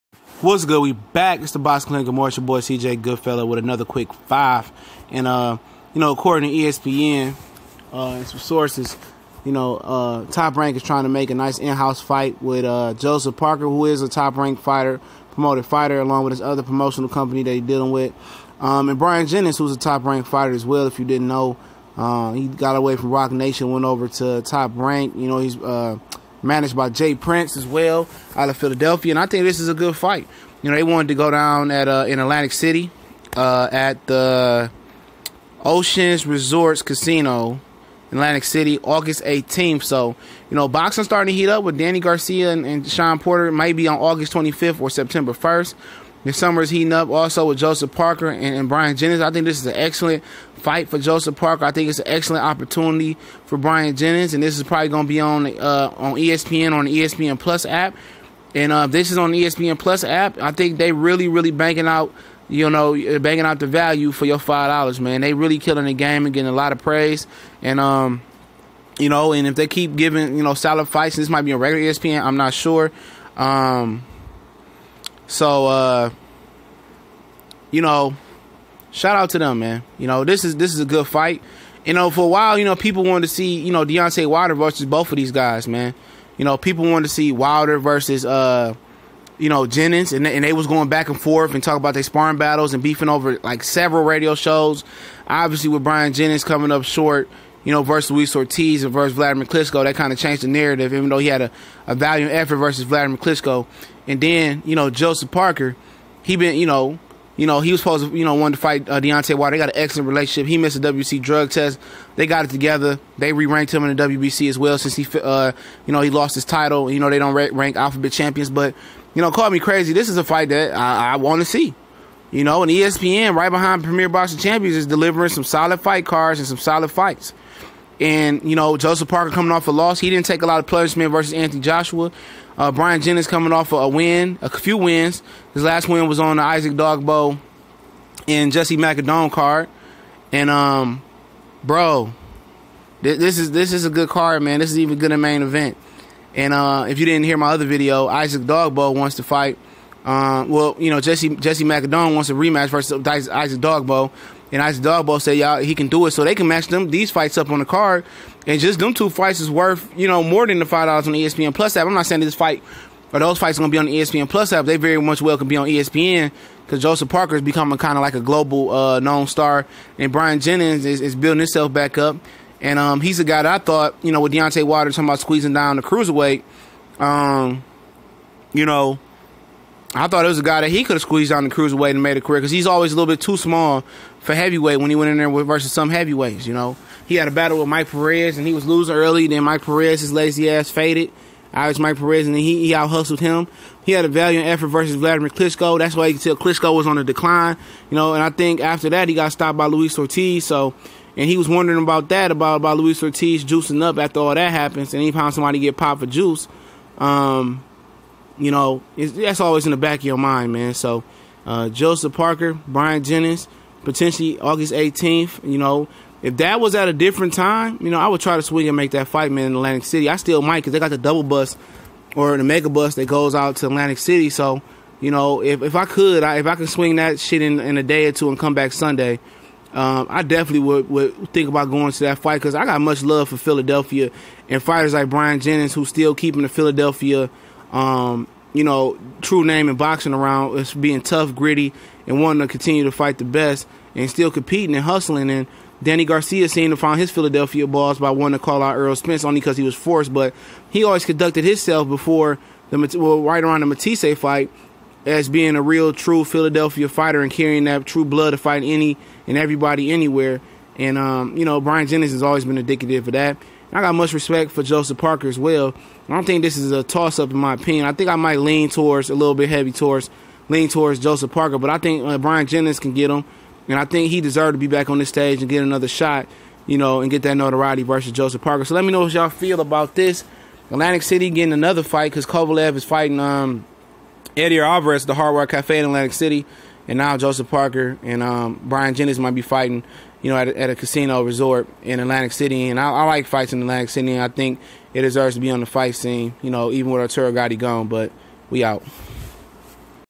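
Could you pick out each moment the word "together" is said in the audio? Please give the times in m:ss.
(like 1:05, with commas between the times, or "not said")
1:52.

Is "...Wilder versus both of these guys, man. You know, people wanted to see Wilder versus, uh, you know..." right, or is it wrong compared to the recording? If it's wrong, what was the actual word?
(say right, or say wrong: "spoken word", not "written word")
right.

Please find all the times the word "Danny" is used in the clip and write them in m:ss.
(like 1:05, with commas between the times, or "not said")
0:41, 4:05.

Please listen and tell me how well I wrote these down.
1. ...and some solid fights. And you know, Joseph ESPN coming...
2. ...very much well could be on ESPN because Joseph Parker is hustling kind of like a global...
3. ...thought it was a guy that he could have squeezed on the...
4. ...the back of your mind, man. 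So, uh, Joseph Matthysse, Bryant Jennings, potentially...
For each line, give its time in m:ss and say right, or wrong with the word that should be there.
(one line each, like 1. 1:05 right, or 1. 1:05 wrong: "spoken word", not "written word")
1. 2:06 wrong: "Parker", not "ESPN"
2. 2:44 wrong: "becoming", not "hustling"
3. 3:00 right
4. 3:29 wrong: "Parker", not "Matthysse".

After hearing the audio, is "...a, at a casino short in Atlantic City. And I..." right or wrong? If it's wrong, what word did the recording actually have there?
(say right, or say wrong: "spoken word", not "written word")
wrong: "resort", not "short".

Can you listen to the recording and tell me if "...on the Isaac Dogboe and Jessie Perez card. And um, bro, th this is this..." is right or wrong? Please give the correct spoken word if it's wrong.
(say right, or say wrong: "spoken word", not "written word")
wrong: "Magdaleno", not "Perez".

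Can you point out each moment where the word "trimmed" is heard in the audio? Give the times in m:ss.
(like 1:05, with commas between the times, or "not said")
not said.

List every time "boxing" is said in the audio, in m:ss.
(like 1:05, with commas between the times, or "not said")
0:40, 2:04, 3:59.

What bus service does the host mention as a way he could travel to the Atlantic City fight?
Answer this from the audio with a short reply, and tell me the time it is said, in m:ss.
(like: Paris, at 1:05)
Mega bus, at 3:42.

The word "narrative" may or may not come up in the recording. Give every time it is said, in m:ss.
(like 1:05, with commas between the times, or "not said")
1:40.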